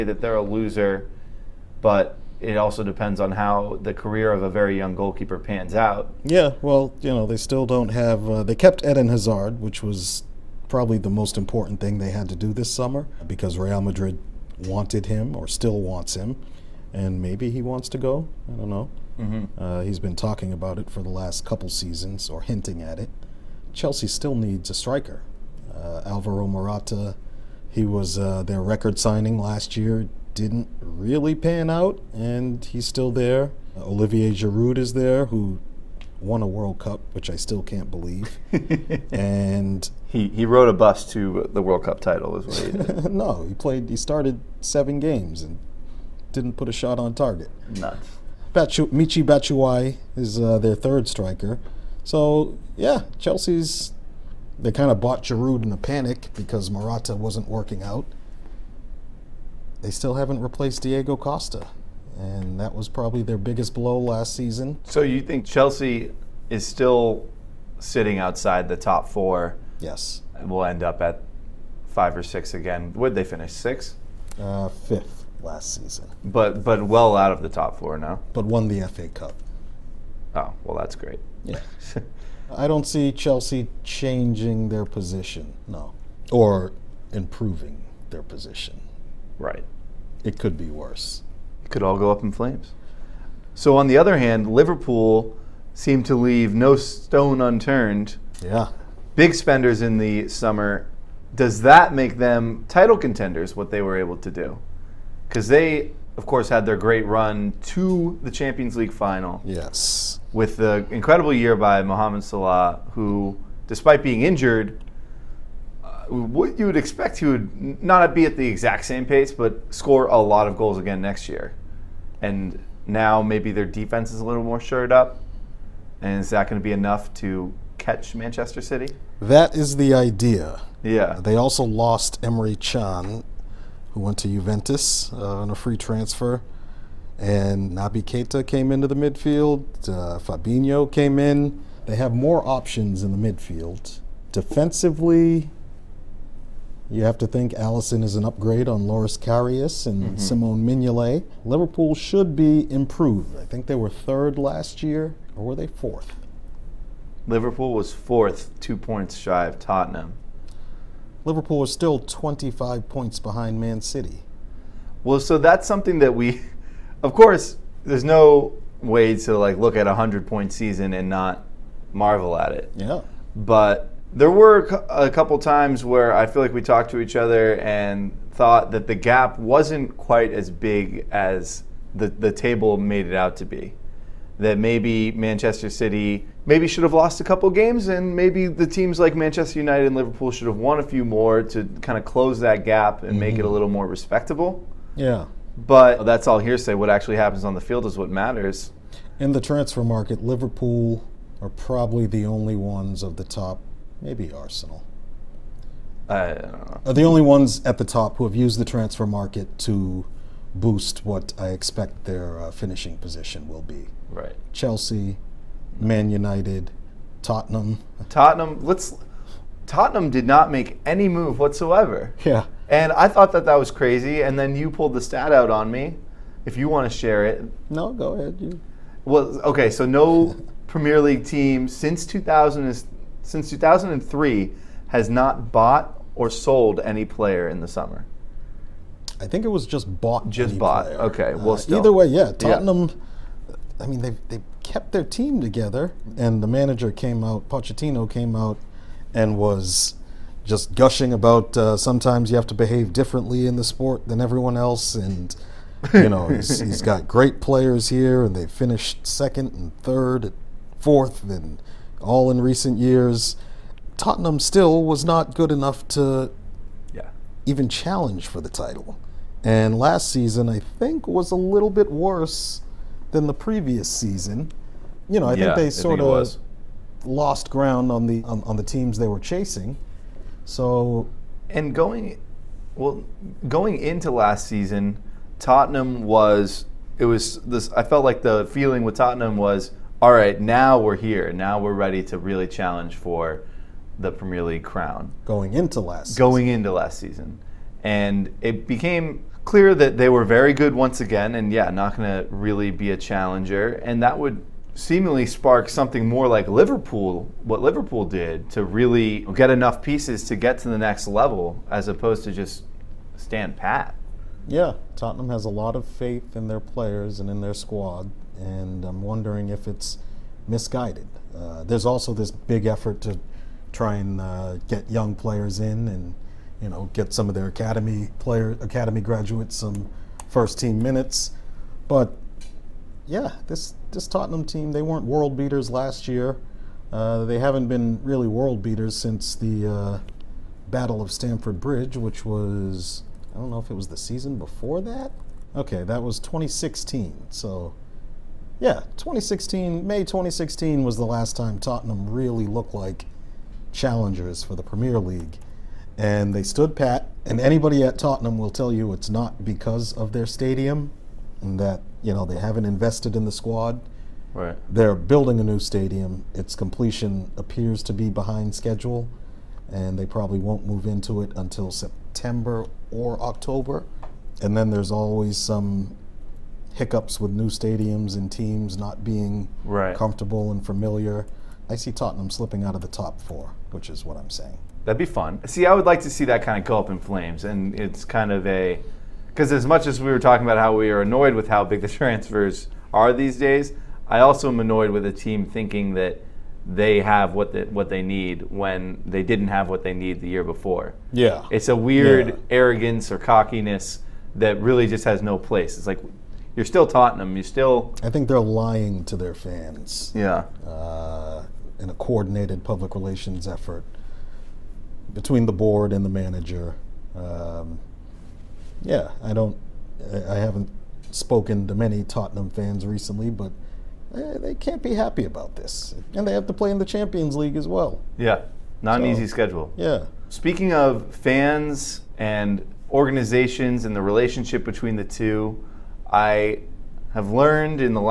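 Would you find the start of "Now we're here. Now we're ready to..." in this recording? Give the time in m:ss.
4:50.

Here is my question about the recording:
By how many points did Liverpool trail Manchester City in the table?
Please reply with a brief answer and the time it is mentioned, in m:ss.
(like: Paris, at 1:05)
25, at 2:41.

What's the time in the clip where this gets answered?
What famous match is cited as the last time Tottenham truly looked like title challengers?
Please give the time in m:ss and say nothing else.
5:40.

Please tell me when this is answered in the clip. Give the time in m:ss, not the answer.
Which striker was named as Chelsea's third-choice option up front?
0:48.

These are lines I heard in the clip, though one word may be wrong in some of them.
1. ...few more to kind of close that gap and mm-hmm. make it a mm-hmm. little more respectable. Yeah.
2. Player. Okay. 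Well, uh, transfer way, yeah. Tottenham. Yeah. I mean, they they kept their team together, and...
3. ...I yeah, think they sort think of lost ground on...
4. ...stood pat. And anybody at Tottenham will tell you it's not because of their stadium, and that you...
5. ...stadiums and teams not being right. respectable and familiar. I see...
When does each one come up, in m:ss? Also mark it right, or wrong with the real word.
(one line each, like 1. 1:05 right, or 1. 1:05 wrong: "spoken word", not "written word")
1. 3:10 right
2. 4:00 wrong: "either", not "transfer"
3. 4:35 right
4. 5:56 right
5. 6:17 wrong: "comfortable", not "respectable".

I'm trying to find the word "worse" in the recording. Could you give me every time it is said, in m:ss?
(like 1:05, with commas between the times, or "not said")
1:30, 4:31.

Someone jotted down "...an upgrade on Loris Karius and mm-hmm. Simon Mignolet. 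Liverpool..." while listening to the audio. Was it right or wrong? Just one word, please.
right.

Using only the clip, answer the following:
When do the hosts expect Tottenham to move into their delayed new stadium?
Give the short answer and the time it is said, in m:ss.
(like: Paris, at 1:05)
September or October, at 6:11.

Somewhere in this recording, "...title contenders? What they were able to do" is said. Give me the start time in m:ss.
1:42.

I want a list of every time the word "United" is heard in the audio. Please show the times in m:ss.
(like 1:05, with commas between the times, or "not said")
3:09, 3:36.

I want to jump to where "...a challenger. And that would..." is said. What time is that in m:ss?
5:02.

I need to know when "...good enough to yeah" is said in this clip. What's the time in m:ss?
4:25.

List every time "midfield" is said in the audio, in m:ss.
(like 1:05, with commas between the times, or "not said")
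2:18, 2:23.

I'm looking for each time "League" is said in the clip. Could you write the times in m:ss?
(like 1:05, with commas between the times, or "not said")
1:48, 3:51, 4:54, 5:54, 7:07.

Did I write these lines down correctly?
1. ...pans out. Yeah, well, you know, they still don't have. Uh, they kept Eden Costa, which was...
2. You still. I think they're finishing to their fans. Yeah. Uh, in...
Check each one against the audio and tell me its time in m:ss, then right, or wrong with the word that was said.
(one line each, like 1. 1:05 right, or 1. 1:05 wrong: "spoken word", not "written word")
1. 0:05 wrong: "Hazard", not "Costa"
2. 6:47 wrong: "lying", not "finishing".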